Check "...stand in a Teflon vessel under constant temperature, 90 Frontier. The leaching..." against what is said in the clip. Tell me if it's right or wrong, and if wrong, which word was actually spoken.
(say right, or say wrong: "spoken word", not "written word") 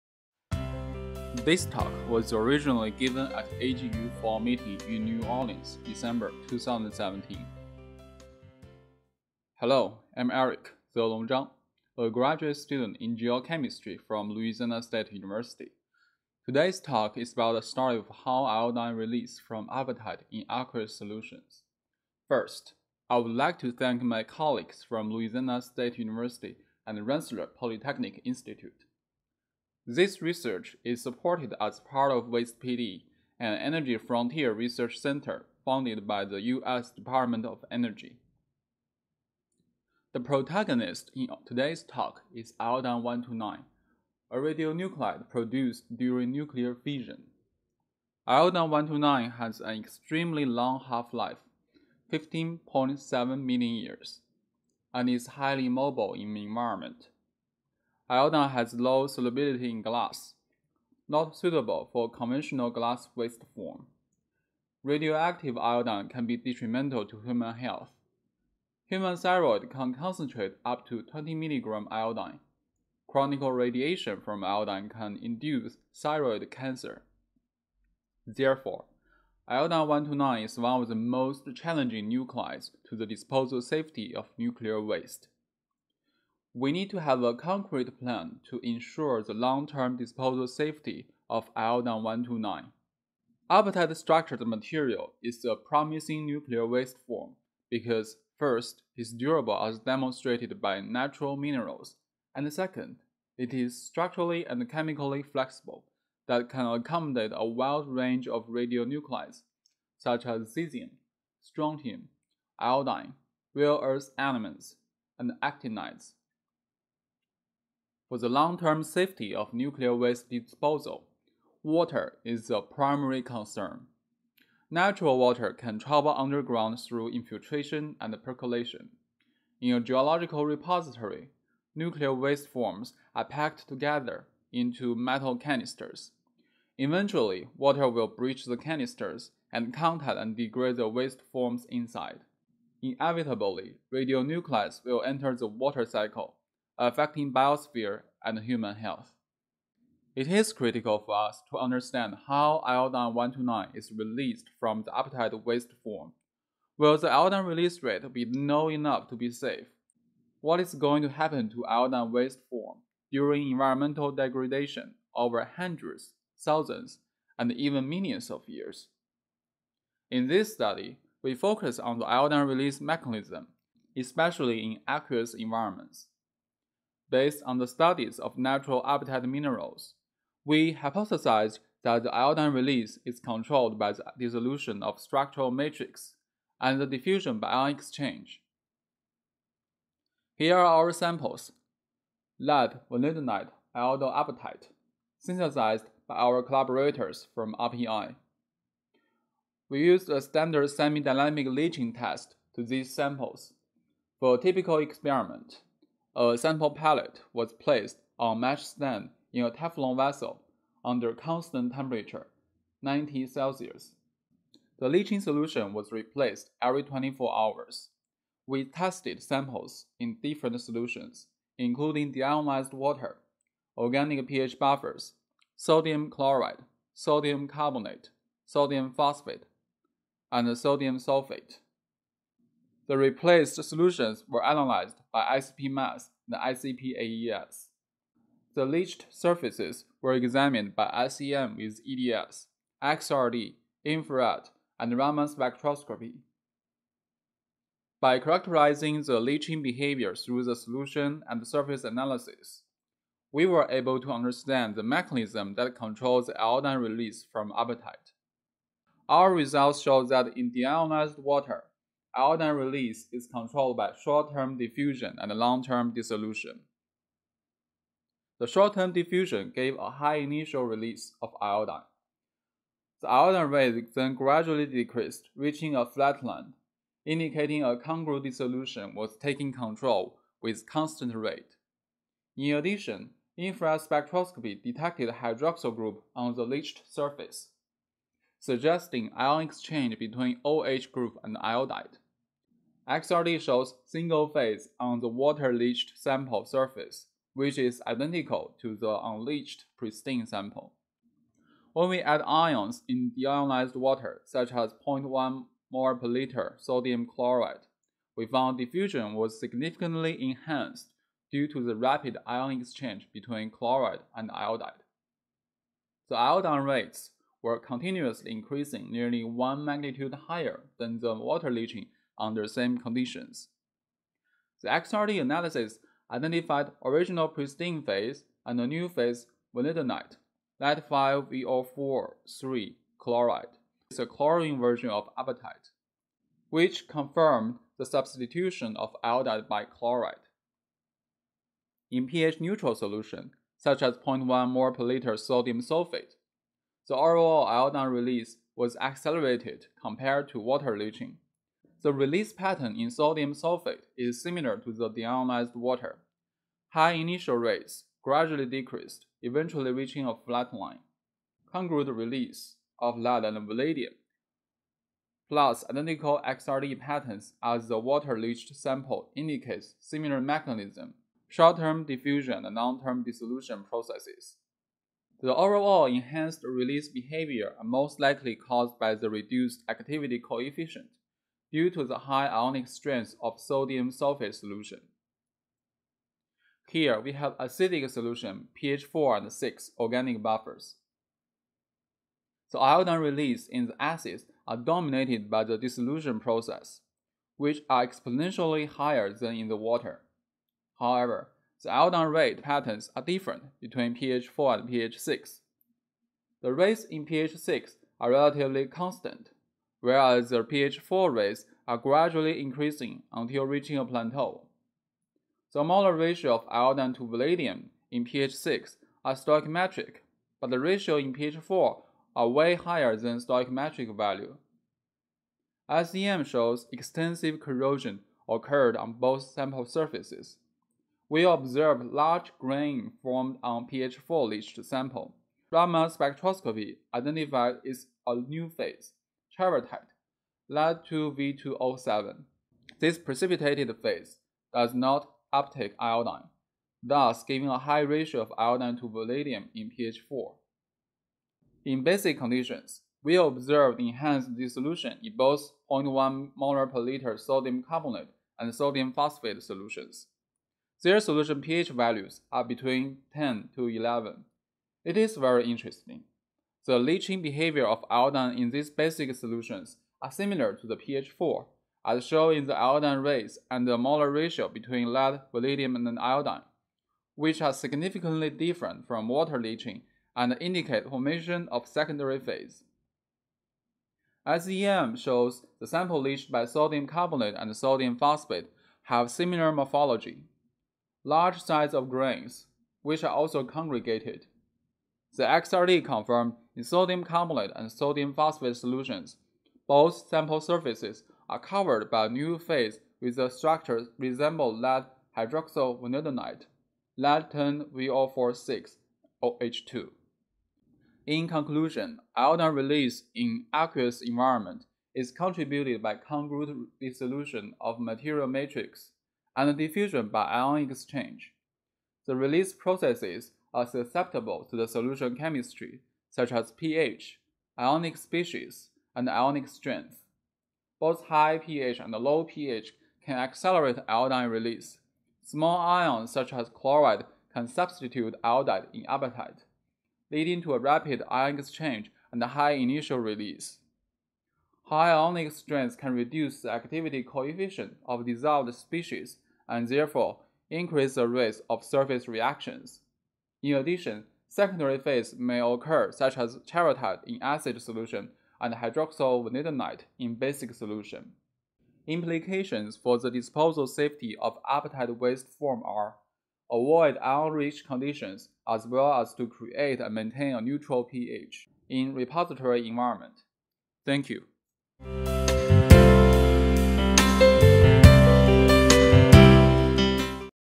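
wrong: "Celsius", not "Frontier".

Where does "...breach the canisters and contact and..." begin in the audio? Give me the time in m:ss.
2:18.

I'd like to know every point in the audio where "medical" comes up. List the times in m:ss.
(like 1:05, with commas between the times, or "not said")
not said.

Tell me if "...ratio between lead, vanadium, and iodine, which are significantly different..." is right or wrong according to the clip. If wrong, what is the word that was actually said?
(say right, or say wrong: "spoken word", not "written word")
right.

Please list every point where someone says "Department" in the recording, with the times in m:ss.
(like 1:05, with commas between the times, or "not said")
0:36.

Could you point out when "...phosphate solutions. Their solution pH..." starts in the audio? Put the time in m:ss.
7:38.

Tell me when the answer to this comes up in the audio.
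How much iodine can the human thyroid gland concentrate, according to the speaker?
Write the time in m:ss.
1:11.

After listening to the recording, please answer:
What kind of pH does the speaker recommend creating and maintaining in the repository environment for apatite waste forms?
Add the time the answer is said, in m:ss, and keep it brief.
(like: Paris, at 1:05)
Neutral pH, at 9:30.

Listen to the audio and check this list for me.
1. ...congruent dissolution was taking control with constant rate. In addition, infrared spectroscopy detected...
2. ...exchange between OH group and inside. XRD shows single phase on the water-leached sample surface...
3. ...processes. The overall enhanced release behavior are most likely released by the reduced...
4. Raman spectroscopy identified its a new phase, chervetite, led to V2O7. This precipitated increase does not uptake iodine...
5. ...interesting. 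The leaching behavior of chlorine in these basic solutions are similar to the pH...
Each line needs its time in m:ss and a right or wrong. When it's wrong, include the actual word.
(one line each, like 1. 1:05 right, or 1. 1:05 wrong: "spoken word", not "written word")
1. 4:37 right
2. 4:49 wrong: "iodide", not "inside"
3. 6:13 wrong: "caused", not "released"
4. 7:15 wrong: "phase", not "increase"
5. 7:45 wrong: "iodine", not "chlorine".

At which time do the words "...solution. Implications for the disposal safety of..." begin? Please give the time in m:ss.
9:20.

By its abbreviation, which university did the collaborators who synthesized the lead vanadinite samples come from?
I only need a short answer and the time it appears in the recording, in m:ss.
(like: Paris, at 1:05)
RPI, at 3:17.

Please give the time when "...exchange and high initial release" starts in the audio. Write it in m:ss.
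9:01.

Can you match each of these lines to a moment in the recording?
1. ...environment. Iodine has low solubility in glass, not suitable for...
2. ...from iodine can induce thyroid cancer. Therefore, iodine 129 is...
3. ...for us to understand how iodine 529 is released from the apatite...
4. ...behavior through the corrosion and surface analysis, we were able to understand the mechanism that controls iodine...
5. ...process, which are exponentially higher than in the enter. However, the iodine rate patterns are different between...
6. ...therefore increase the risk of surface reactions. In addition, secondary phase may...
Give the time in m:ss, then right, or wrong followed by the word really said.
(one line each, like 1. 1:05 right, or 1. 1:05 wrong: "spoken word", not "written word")
1. 0:56 right
2. 1:14 right
3. 2:30 wrong: "129", not "529"
4. 4:09 wrong: "solution", not "corrosion"
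5. 6:36 wrong: "water", not "enter"
6. 9:09 right.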